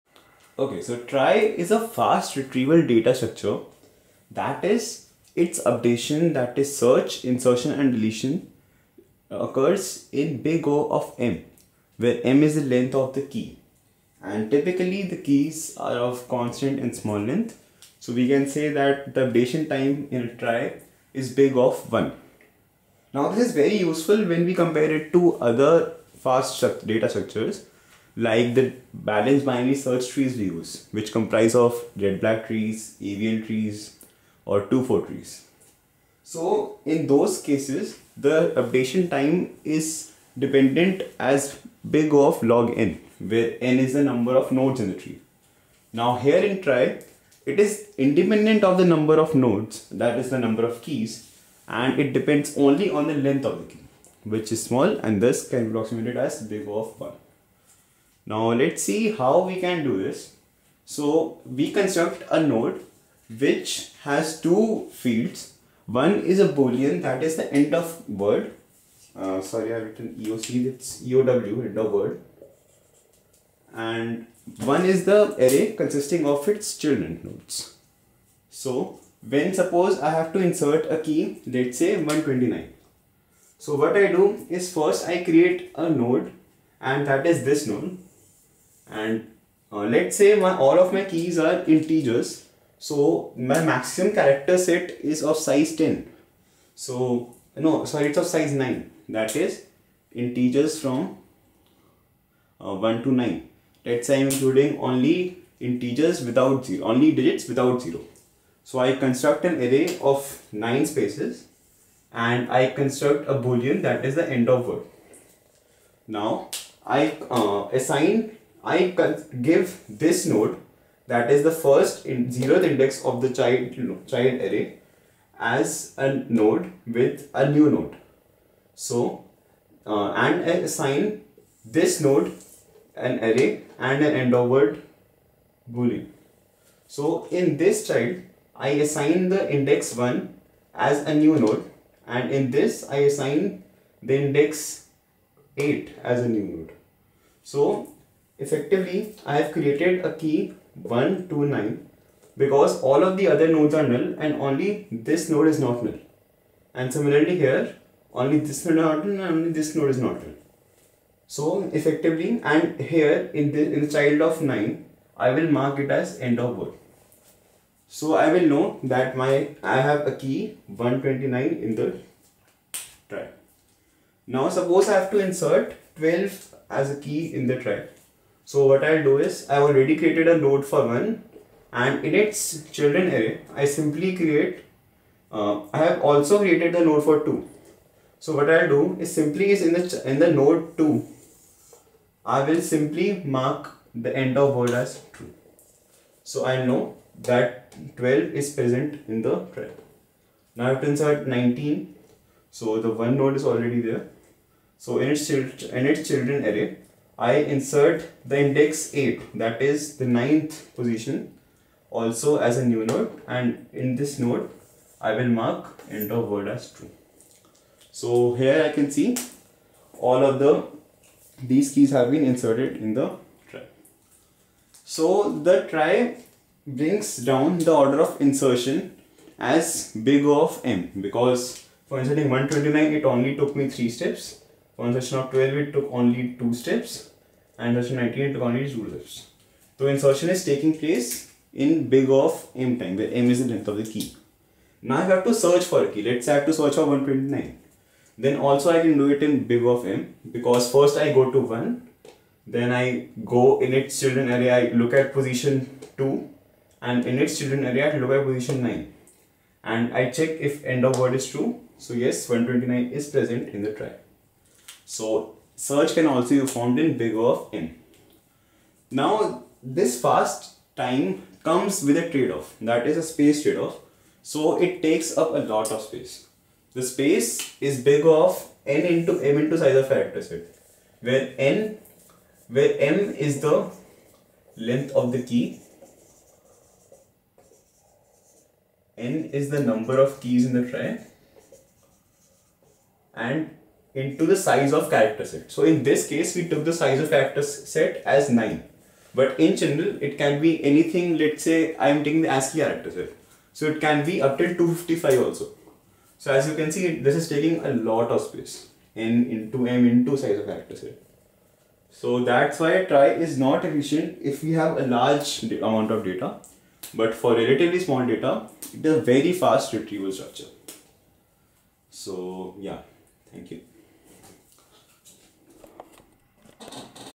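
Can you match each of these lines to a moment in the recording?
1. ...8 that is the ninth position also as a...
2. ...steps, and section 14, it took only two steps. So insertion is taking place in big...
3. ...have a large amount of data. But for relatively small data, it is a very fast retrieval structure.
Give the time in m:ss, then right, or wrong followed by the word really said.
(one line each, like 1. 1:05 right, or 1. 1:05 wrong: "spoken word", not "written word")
1. 3:28 right
2. 3:56 wrong: "19", not "14"
3. 5:14 right.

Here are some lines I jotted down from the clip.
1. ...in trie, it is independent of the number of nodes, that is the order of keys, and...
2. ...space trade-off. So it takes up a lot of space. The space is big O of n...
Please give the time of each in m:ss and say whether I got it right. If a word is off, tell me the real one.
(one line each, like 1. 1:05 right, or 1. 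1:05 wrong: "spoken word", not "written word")
1. 0:46 wrong: "number", not "order"
2. 4:33 right.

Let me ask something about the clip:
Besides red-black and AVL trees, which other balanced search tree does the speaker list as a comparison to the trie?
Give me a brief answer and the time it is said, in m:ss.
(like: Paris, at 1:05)
2-4 trees, at 0:34.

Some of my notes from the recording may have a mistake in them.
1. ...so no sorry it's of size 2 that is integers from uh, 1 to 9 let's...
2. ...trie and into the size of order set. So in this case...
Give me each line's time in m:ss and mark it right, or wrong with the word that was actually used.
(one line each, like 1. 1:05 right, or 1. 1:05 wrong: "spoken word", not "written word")
1. 1:36 wrong: "9", not "2"
2. 4:50 wrong: "character", not "order".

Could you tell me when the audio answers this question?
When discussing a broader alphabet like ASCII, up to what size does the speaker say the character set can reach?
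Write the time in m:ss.
5:04.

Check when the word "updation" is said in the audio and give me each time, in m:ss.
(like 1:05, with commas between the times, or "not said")
0:05, 0:19, 0:38.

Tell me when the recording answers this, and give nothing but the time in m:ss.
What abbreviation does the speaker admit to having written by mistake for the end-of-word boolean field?
1:10.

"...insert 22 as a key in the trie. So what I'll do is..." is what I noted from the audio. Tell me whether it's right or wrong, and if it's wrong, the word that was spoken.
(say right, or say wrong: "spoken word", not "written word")
wrong: "12", not "22".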